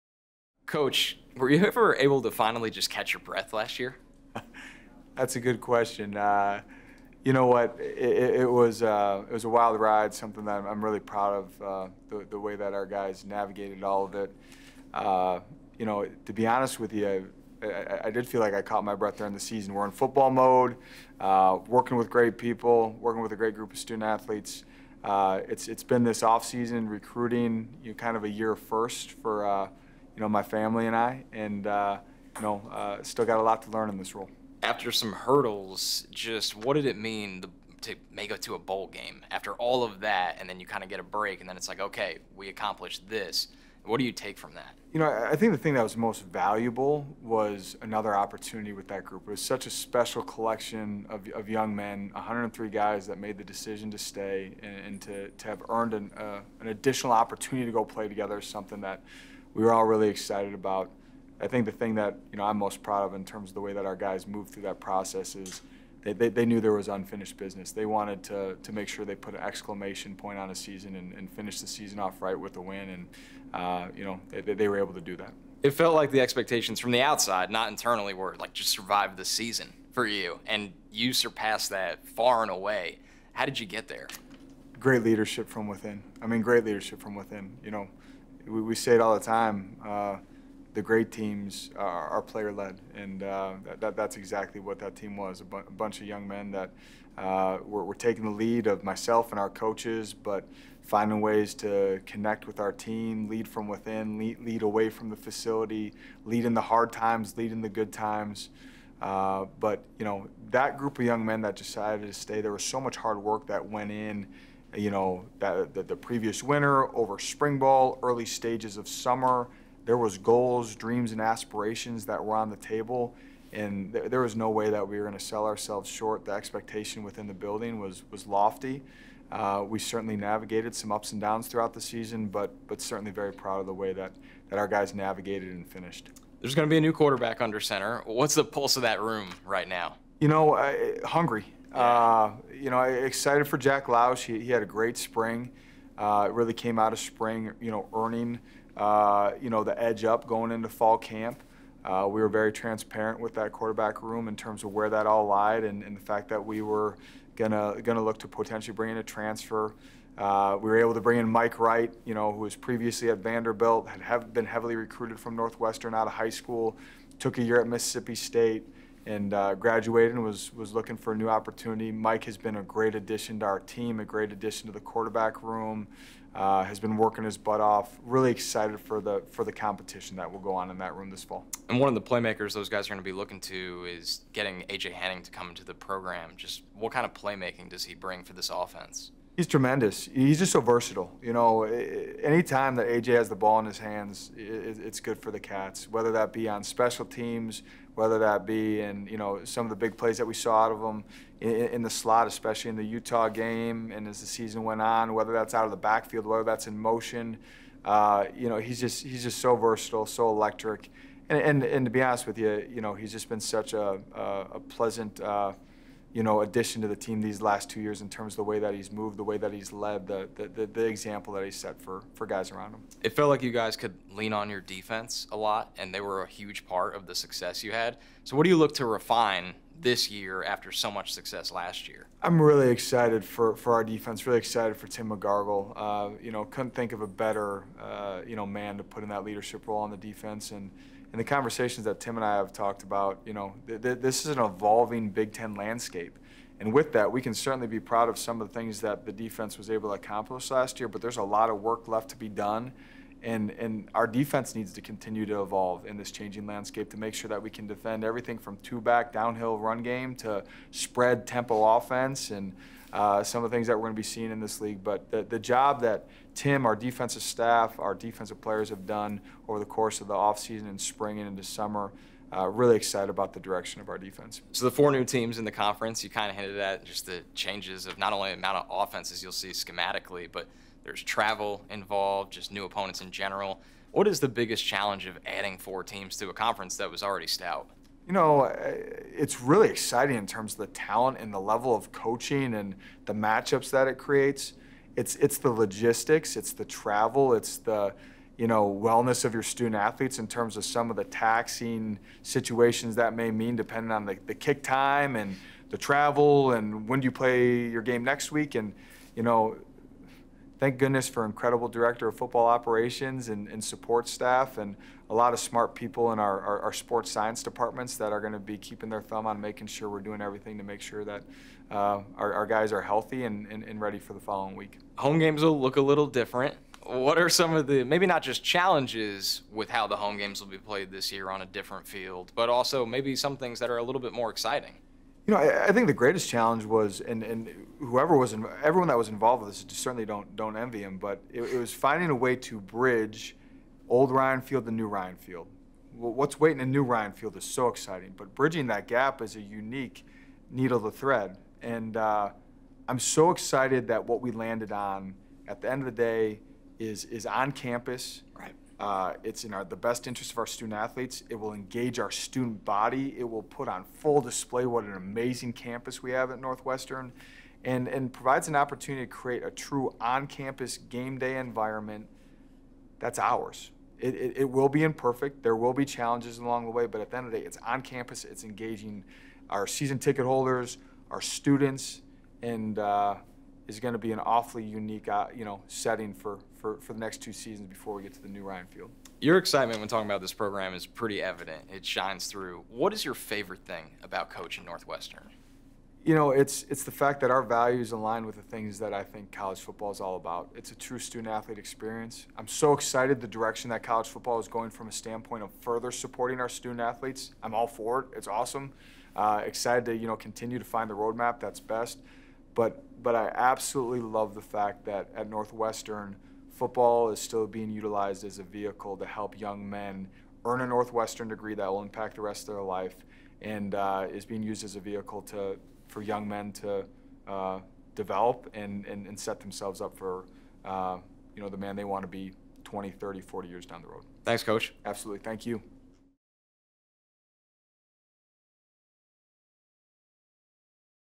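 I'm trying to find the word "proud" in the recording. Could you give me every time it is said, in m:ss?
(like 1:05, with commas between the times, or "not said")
0:11, 1:02, 2:13, 4:07.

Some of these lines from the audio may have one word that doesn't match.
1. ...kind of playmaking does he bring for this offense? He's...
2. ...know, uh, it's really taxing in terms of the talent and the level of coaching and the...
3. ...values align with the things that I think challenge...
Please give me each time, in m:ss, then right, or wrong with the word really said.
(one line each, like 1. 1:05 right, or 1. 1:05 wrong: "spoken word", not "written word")
1. 3:06 right
2. 4:48 wrong: "exciting", not "taxing"
3. 6:37 wrong: "college", not "challenge".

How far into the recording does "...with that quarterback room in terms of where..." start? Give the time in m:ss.
2:33.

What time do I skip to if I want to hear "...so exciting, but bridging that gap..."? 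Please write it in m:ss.
5:47.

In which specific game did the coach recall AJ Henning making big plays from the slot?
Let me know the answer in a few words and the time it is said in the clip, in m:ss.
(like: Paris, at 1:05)
Utah, at 3:22.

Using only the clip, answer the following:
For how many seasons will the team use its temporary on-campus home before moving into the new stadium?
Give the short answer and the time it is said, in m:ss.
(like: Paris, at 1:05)
2, at 6:27.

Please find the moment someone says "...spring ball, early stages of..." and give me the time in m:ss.
1:57.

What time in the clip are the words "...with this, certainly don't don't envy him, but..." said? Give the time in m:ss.
5:39.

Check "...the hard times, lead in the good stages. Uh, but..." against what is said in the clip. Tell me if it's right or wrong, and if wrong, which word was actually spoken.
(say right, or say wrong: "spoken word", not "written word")
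wrong: "times", not "stages".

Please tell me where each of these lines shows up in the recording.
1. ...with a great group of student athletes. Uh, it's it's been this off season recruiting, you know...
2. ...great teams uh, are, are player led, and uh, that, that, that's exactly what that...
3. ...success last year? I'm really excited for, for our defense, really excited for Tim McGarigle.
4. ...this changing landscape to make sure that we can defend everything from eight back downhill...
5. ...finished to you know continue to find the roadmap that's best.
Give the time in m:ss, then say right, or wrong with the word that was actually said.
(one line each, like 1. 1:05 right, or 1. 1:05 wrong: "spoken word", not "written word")
1. 0:23 right
2. 1:30 right
3. 3:51 right
4. 4:15 wrong: "two", not "eight"
5. 6:49 wrong: "excited", not "finished".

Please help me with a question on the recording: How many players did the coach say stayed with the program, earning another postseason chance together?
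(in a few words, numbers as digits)
103.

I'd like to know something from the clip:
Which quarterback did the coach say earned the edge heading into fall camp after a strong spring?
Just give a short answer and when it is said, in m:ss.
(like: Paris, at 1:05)
Jack Lausch, at 2:23.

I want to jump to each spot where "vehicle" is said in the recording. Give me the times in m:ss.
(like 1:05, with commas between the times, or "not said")
6:58, 7:04.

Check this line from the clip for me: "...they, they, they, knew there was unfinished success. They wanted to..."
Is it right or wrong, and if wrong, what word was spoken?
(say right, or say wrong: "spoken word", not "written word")
wrong: "business", not "success".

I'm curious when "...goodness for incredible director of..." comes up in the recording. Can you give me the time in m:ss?
5:10.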